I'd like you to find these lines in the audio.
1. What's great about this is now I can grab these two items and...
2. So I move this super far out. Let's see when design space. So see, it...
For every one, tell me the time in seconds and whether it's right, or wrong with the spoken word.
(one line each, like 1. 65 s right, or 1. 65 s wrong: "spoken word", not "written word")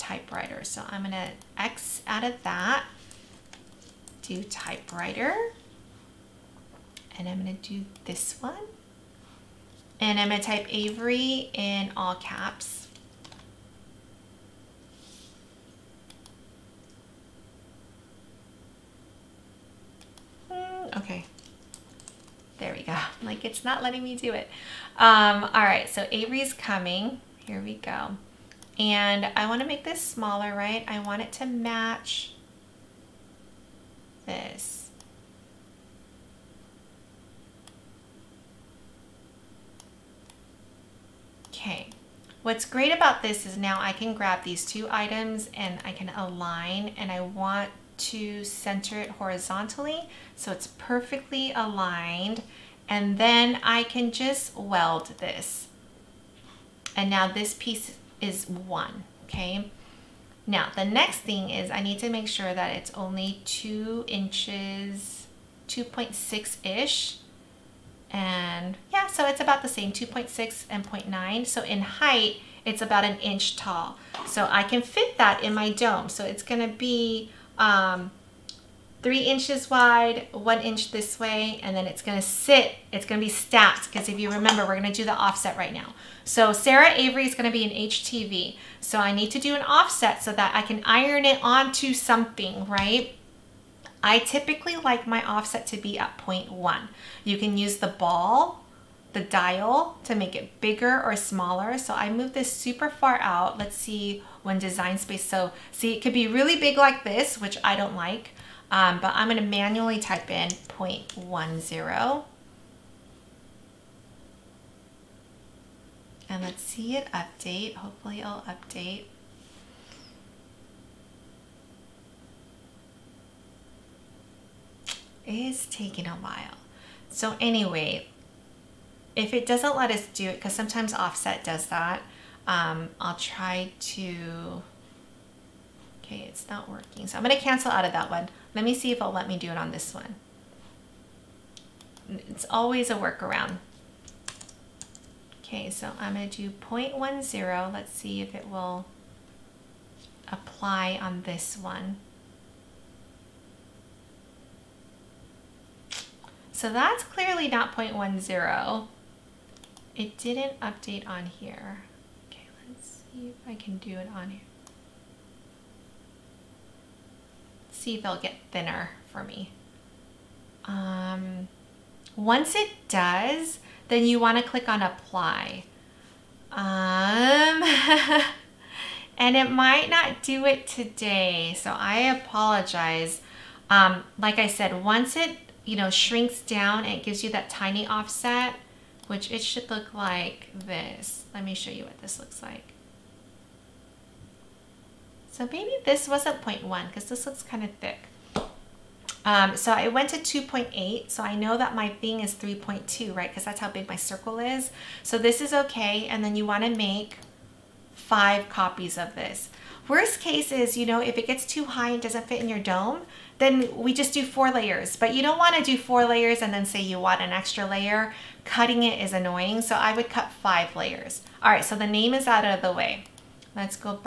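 1. 42 s right
2. 101 s right.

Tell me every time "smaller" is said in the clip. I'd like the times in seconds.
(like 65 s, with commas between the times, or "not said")
29 s, 101 s.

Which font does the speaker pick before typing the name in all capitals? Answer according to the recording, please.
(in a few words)
Typewriter.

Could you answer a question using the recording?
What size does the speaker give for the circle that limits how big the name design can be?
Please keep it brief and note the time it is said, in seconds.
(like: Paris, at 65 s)
3.2, at 202 s.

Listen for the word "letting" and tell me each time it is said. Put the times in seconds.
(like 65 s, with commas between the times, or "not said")
23 s.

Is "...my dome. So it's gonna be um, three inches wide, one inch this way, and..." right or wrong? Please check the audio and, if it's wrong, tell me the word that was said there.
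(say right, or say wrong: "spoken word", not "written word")
right.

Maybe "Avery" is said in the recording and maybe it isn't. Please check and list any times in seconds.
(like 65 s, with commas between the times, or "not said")
10 s, 26 s, 86 s.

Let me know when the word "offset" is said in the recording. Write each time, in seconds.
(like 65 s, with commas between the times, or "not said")
85 s, 89 s, 95 s, 130 s, 187 s.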